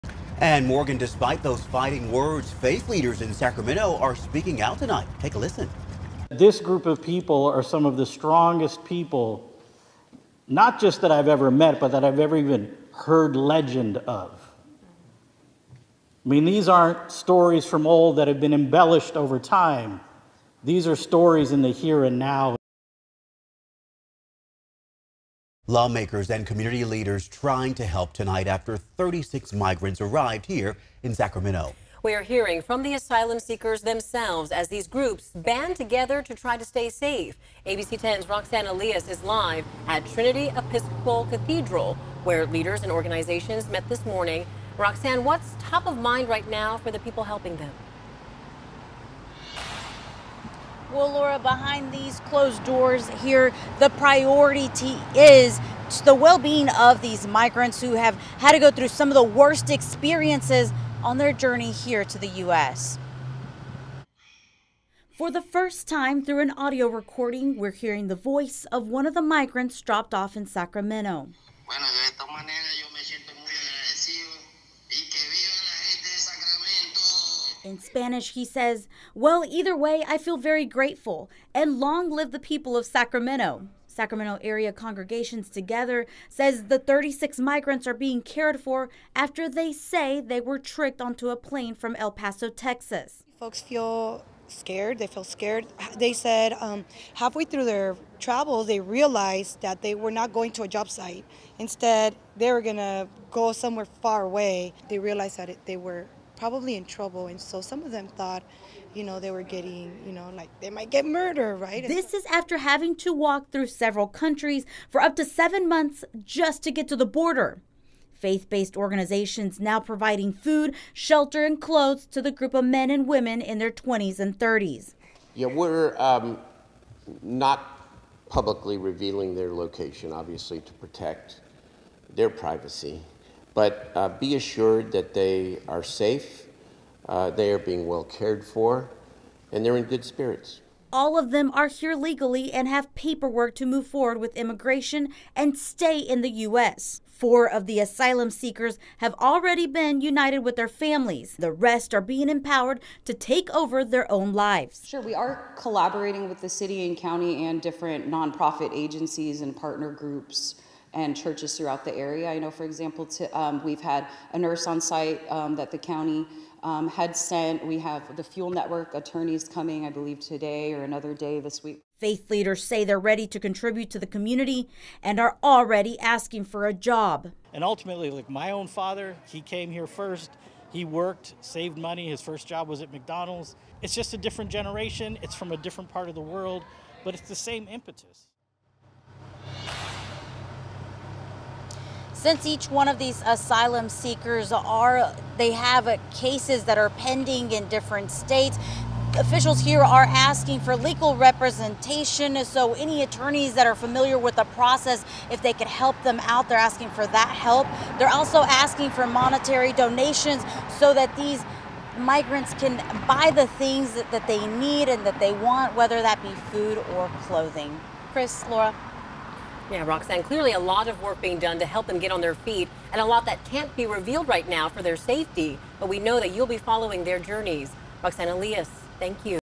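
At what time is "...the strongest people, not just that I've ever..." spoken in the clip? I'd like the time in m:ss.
0:07.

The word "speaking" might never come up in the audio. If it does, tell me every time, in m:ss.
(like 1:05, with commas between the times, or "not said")
0:04.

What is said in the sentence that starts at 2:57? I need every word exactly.
And ultimately, like my own father, he came here first.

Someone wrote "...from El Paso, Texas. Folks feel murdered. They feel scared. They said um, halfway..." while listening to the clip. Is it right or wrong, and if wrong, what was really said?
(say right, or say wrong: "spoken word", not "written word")
wrong: "scared", not "murdered".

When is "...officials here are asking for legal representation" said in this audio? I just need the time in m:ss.
3:19.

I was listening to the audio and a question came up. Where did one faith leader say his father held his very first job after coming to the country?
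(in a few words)
McDonald's.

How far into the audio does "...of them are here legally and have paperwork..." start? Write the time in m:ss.
2:21.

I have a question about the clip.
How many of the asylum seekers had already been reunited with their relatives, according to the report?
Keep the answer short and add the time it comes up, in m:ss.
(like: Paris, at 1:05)
4, at 2:27.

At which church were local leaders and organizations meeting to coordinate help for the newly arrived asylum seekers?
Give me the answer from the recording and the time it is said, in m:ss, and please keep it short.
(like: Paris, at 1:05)
Trinity Episcopal Cathedral, at 0:40.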